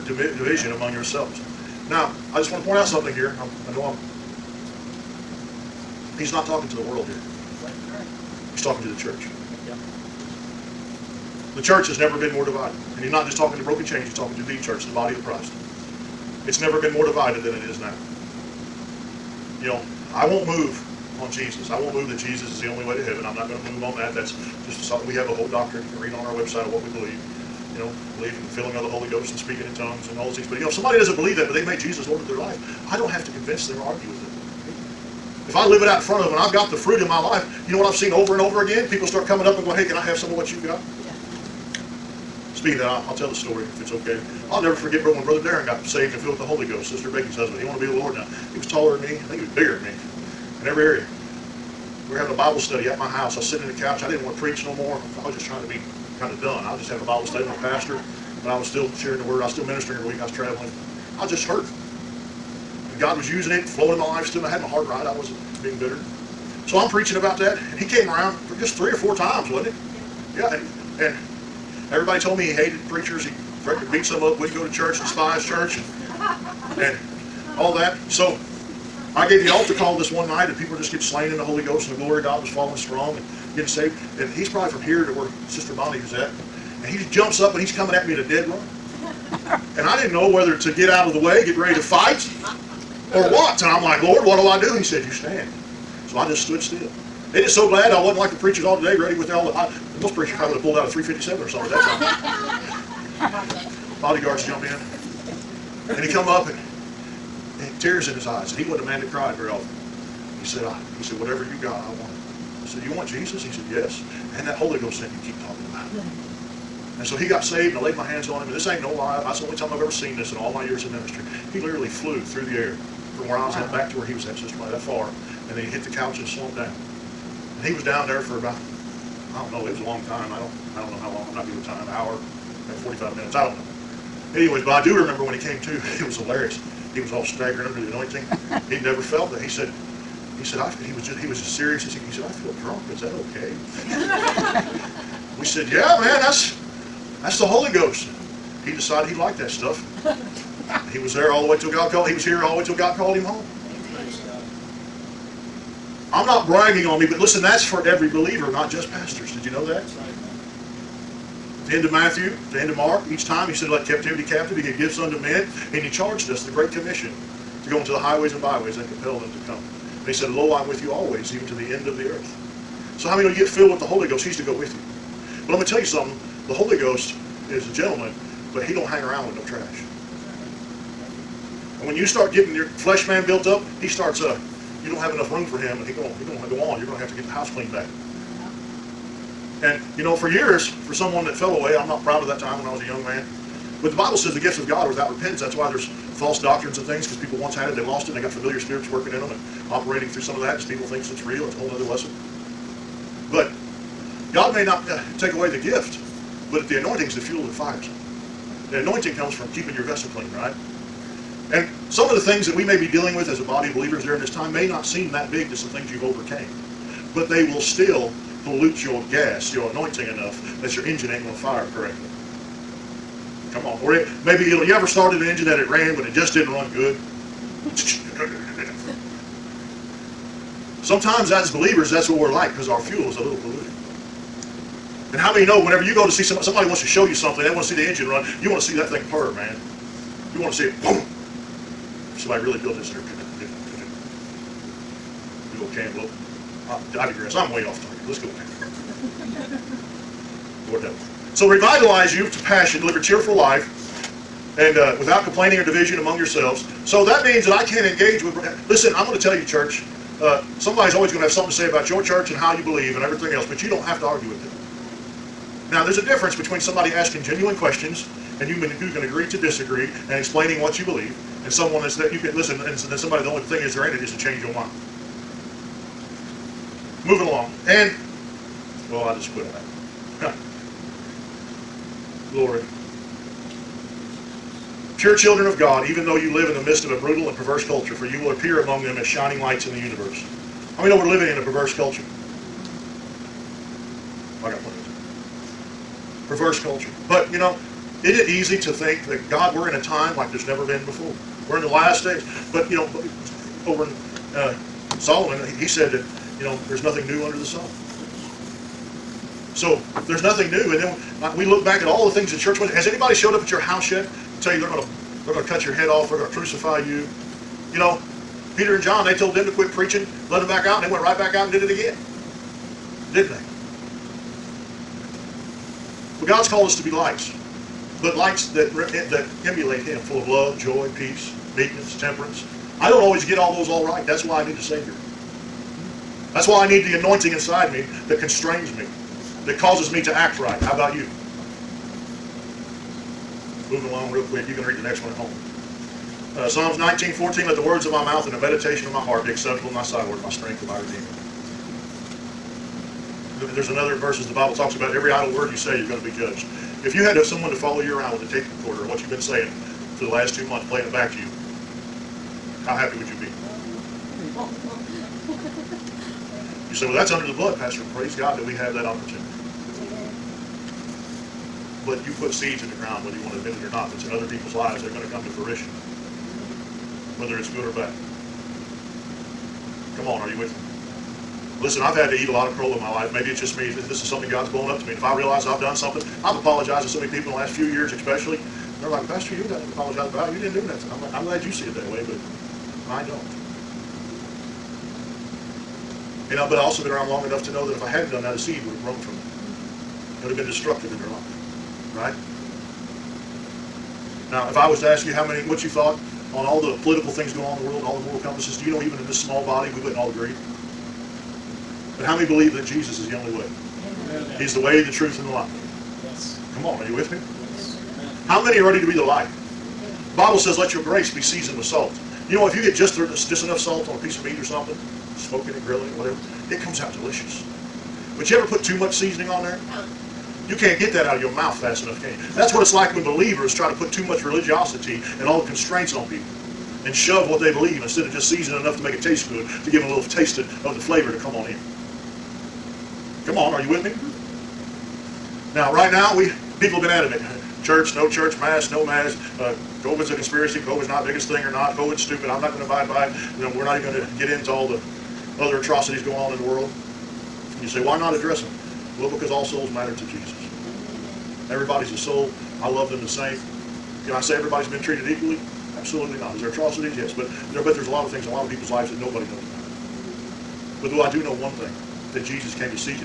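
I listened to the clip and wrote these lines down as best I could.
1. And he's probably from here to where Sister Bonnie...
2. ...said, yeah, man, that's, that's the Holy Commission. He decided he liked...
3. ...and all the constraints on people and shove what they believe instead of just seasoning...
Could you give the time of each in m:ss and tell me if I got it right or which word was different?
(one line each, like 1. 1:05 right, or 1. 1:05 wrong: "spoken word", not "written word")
1. 1:24 right
2. 2:25 wrong: "Ghost", not "Commission"
3. 7:15 right.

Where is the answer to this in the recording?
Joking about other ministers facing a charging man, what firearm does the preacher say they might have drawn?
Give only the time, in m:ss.
1:40.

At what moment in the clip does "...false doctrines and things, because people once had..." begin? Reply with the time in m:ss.
3:15.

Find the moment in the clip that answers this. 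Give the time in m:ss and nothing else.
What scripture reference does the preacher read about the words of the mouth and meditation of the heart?
5:46.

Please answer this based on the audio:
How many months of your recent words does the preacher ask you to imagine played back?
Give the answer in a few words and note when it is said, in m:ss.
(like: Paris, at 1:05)
2, at 6:00.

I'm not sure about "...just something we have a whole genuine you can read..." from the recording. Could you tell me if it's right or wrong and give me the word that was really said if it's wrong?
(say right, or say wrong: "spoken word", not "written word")
wrong: "doctrine", not "genuine".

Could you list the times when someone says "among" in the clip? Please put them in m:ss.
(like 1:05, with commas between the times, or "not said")
0:00, 4:15, 4:48.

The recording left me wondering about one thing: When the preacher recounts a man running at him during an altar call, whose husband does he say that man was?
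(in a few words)
Sister Bacon's.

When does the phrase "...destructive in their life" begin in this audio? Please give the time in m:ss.
6:40.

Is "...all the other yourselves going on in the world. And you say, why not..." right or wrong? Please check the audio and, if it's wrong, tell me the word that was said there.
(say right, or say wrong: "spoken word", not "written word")
wrong: "atrocities", not "yourselves".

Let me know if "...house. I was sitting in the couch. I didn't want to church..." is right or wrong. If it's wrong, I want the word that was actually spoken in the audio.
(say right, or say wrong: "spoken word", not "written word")
wrong: "preach", not "church".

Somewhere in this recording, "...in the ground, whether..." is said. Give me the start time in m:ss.
6:12.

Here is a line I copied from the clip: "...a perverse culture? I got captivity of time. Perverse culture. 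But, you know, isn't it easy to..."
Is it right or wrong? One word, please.
wrong.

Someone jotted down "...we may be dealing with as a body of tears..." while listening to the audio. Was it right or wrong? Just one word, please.
wrong.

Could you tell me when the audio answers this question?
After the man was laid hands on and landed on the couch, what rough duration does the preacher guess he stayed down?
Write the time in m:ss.
2:12.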